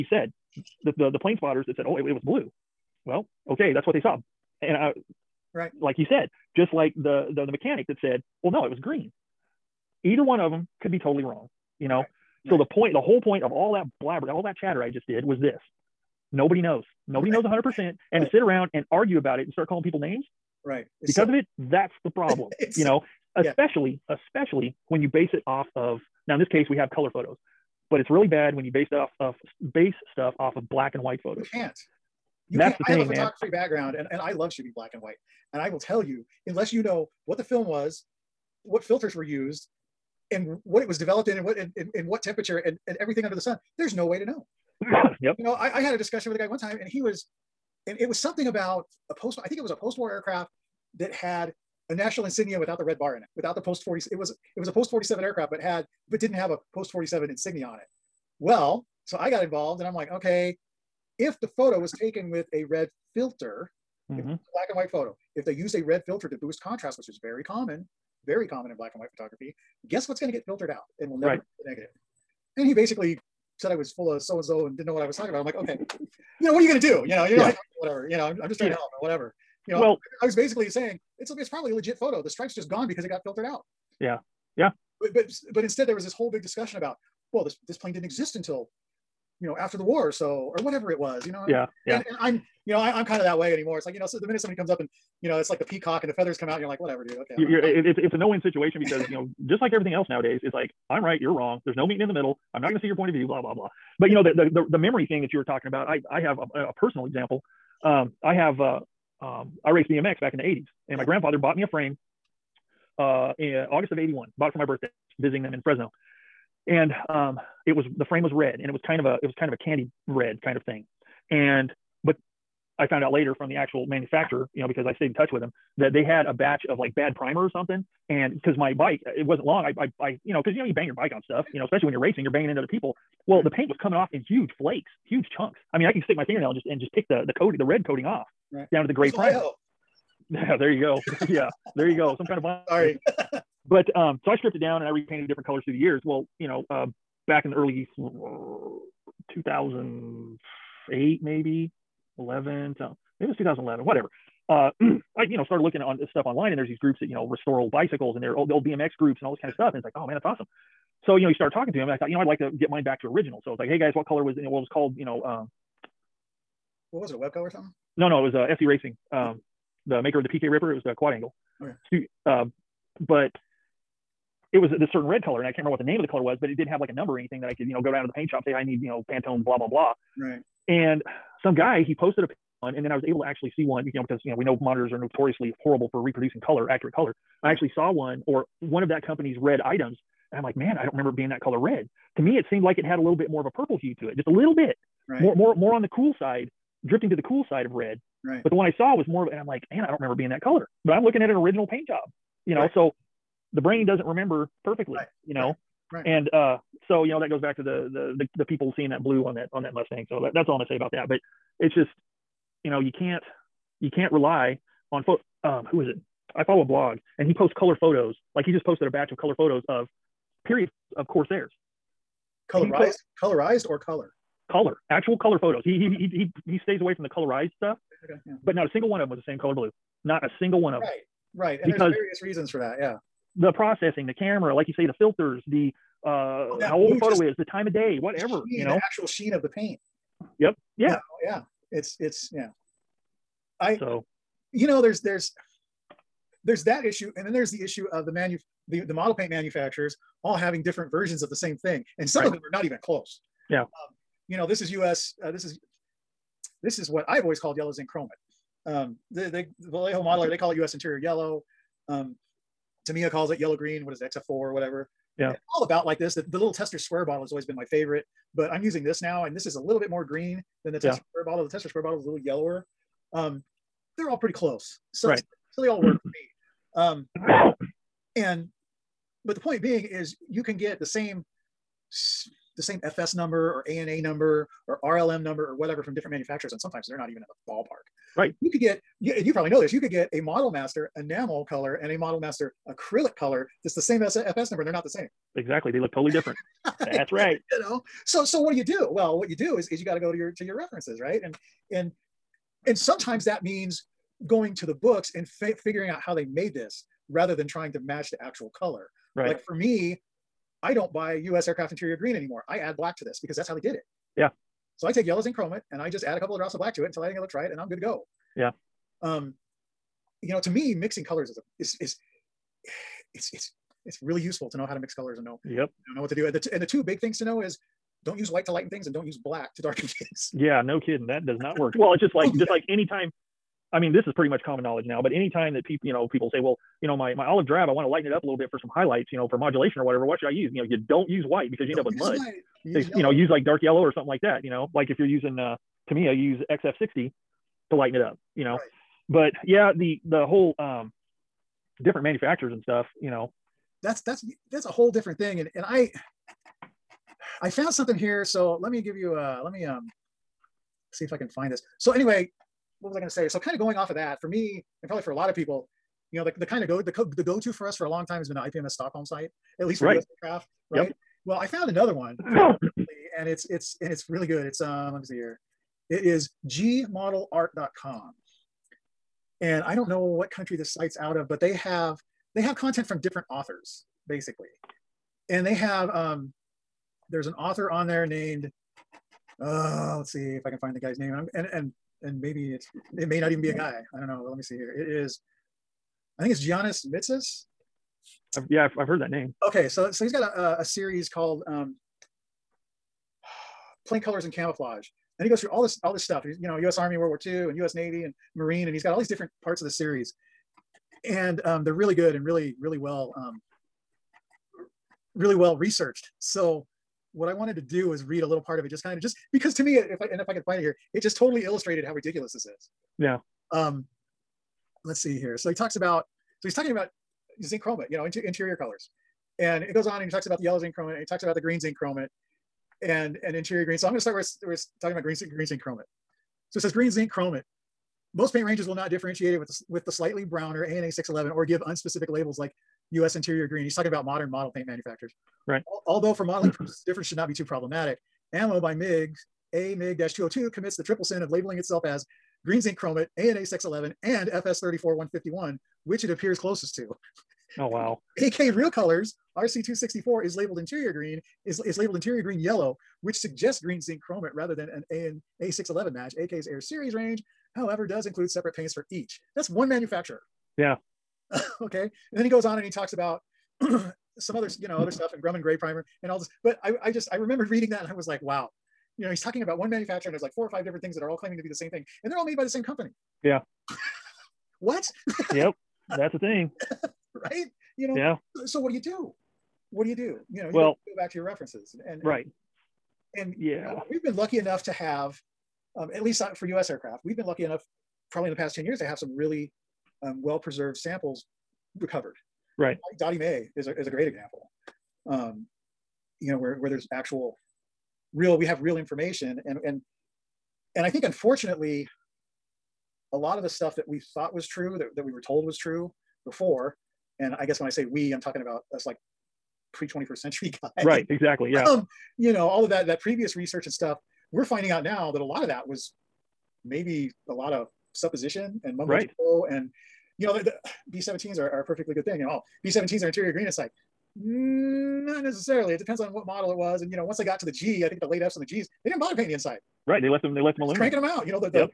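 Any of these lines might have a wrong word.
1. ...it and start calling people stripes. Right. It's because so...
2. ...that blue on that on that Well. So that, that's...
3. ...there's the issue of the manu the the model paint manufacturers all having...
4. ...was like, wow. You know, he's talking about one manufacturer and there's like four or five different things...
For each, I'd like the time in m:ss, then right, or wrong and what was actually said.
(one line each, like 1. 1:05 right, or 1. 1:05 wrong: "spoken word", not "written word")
1. 0:19 wrong: "names", not "stripes"
2. 3:28 wrong: "Mustang", not "Well"
3. 4:07 right
4. 7:57 right.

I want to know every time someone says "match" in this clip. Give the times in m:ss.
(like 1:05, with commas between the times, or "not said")
5:07, 7:45.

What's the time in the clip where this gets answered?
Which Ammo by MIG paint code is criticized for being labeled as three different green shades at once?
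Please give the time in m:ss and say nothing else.
7:29.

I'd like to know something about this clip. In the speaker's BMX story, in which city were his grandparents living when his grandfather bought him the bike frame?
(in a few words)
Fresno.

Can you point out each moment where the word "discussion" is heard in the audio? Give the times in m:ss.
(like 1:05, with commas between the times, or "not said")
0:45, 1:26.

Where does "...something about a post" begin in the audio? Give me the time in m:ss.
0:48.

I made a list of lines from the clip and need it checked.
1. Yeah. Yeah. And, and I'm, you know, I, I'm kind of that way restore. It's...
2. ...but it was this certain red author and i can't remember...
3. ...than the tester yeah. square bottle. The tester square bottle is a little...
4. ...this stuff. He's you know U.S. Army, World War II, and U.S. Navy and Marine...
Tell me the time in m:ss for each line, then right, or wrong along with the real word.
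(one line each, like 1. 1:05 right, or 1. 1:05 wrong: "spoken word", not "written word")
1. 1:31 wrong: "anymore", not "restore"
2. 2:53 wrong: "color", not "author"
3. 4:30 right
4. 6:45 right.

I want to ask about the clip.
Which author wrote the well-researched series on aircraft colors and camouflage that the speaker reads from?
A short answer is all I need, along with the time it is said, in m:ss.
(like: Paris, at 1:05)
Giannis Mitsis, at 6:36.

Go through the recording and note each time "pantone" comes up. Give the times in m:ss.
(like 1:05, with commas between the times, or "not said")
2:59.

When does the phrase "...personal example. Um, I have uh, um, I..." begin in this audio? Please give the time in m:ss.
1:46.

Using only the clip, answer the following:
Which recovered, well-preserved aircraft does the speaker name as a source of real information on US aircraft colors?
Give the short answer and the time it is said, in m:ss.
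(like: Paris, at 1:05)
Dottie Mae, at 8:22.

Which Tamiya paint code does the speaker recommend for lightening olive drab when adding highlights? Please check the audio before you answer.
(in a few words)
XF60.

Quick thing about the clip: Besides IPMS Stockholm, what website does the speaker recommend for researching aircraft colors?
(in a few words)
gmodelart.com.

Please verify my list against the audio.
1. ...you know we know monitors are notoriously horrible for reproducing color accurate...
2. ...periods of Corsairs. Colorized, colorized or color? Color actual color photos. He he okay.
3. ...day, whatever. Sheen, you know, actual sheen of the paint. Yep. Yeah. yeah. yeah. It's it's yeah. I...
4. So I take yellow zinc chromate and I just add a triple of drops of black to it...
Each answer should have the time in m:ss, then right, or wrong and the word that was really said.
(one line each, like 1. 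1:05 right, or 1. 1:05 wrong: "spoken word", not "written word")
1. 3:04 right
2. 3:40 right
3. 3:57 right
4. 5:14 wrong: "couple", not "triple".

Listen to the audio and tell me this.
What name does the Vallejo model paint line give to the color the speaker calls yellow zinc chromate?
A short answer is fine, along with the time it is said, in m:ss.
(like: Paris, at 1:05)
US interior yellow, at 4:20.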